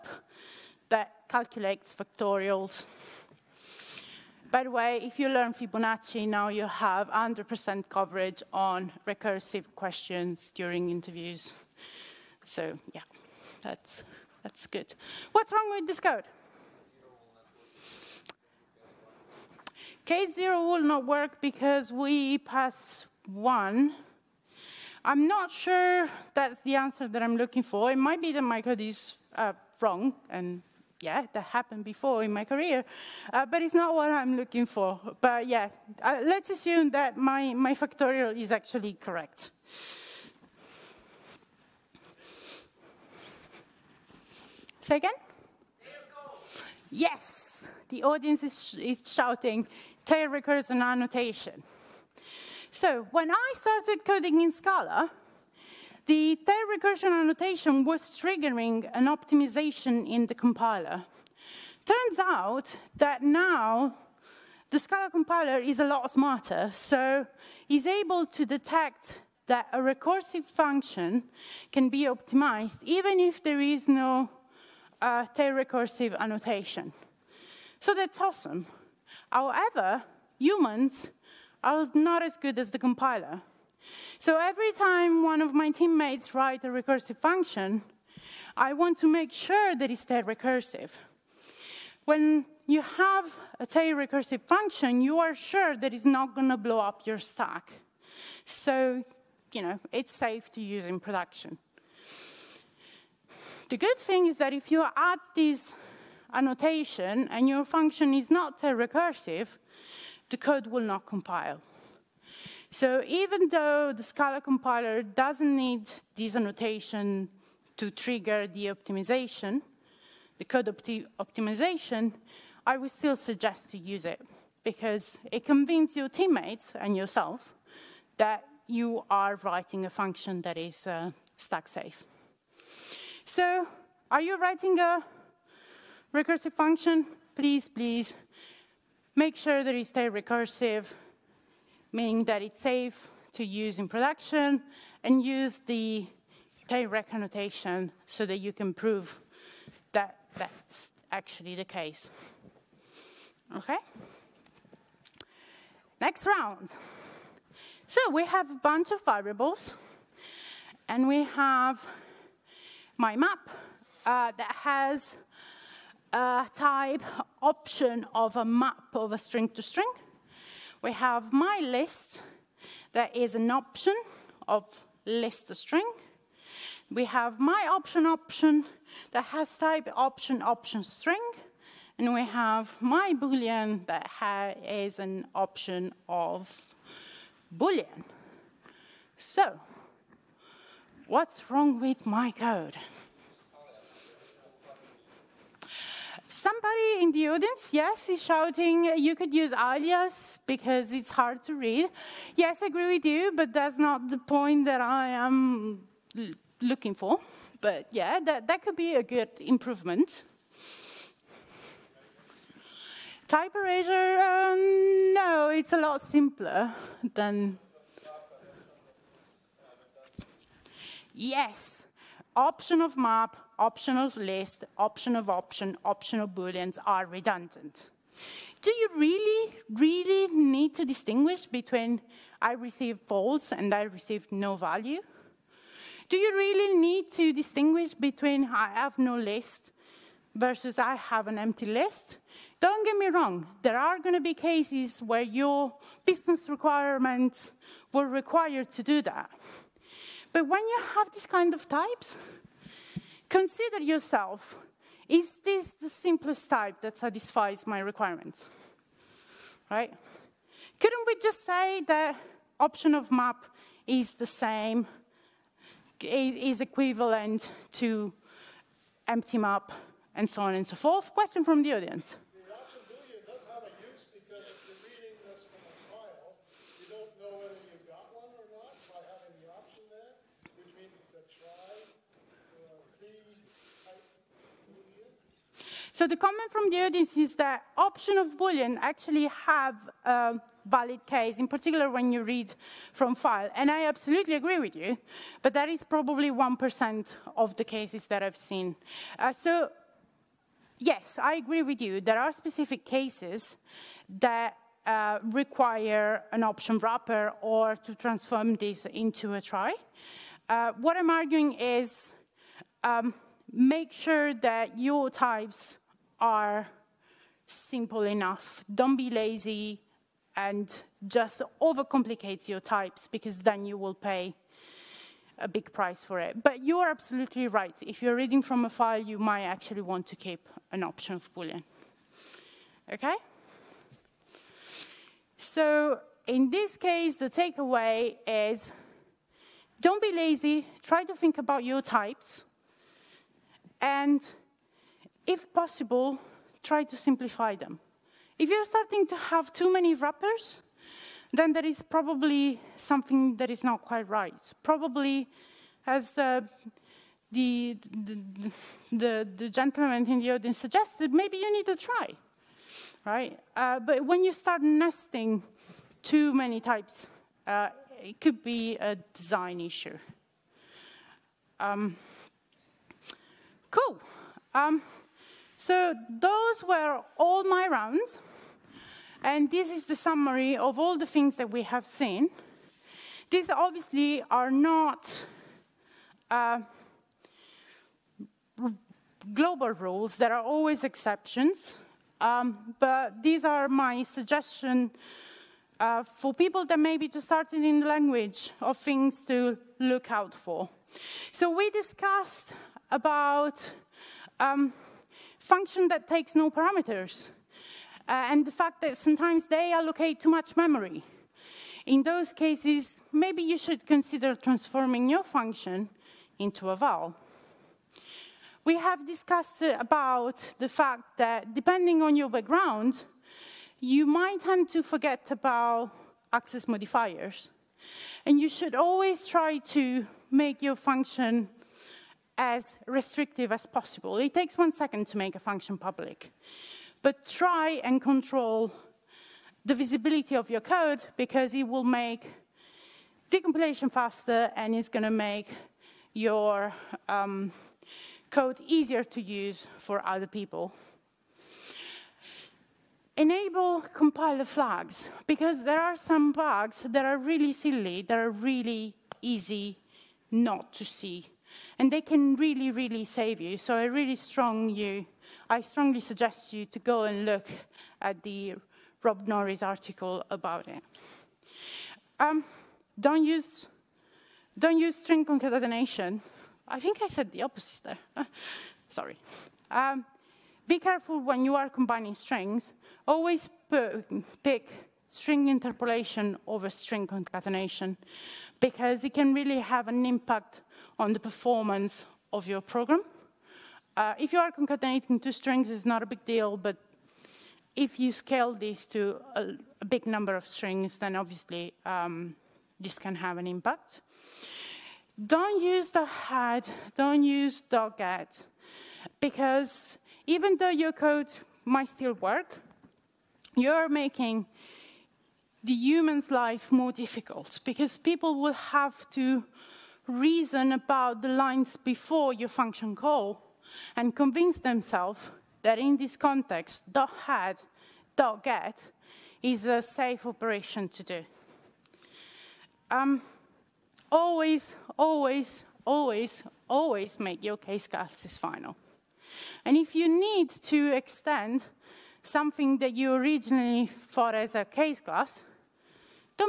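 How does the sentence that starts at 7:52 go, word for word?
Um, don't use don't use string concatenation.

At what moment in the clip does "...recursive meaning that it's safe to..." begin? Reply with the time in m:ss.
2:20.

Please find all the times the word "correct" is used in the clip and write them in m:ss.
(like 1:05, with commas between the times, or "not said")
0:38.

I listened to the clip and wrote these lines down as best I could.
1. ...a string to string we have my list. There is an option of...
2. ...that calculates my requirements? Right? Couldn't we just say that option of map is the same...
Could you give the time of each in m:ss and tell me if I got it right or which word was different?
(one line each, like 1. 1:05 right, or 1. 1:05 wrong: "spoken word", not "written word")
1. 2:49 right
2. 4:16 wrong: "satisfies", not "calculates".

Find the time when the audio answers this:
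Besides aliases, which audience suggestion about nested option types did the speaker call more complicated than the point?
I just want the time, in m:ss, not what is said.
3:33.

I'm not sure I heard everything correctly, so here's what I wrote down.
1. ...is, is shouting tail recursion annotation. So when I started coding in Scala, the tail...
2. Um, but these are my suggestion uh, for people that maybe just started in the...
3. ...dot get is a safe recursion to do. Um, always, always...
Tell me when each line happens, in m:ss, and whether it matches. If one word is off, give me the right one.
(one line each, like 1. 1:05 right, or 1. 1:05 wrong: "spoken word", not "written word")
1. 0:48 right
2. 6:32 right
3. 8:48 wrong: "operation", not "recursion".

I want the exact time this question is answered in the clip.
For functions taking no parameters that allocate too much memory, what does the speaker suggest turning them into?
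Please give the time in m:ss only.
6:56.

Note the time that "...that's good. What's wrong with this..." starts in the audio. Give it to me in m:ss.
0:14.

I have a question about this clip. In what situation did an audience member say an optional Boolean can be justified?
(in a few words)
Reading from a file.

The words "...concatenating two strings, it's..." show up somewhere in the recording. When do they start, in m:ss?
8:14.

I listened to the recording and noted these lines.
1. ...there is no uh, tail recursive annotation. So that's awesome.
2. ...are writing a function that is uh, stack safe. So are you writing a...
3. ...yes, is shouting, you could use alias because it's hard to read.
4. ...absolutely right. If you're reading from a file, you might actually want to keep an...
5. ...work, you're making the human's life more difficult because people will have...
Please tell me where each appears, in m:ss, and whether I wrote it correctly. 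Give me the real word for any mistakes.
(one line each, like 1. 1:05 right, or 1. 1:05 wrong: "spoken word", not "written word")
1. 1:13 right
2. 2:09 right
3. 3:17 right
4. 5:26 right
5. 8:32 right.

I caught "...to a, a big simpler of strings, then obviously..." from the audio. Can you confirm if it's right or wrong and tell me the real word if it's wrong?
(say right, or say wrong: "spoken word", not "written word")
wrong: "number", not "simpler".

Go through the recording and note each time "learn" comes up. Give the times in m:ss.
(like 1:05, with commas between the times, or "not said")
0:05.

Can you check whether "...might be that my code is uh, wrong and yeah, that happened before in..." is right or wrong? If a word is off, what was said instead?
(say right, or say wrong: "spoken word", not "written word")
right.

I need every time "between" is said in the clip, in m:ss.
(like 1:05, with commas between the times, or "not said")
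3:51, 3:57.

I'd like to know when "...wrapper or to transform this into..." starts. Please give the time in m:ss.
5:06.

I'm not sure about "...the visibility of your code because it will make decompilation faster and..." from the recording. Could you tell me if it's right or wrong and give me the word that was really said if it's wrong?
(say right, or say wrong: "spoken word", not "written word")
right.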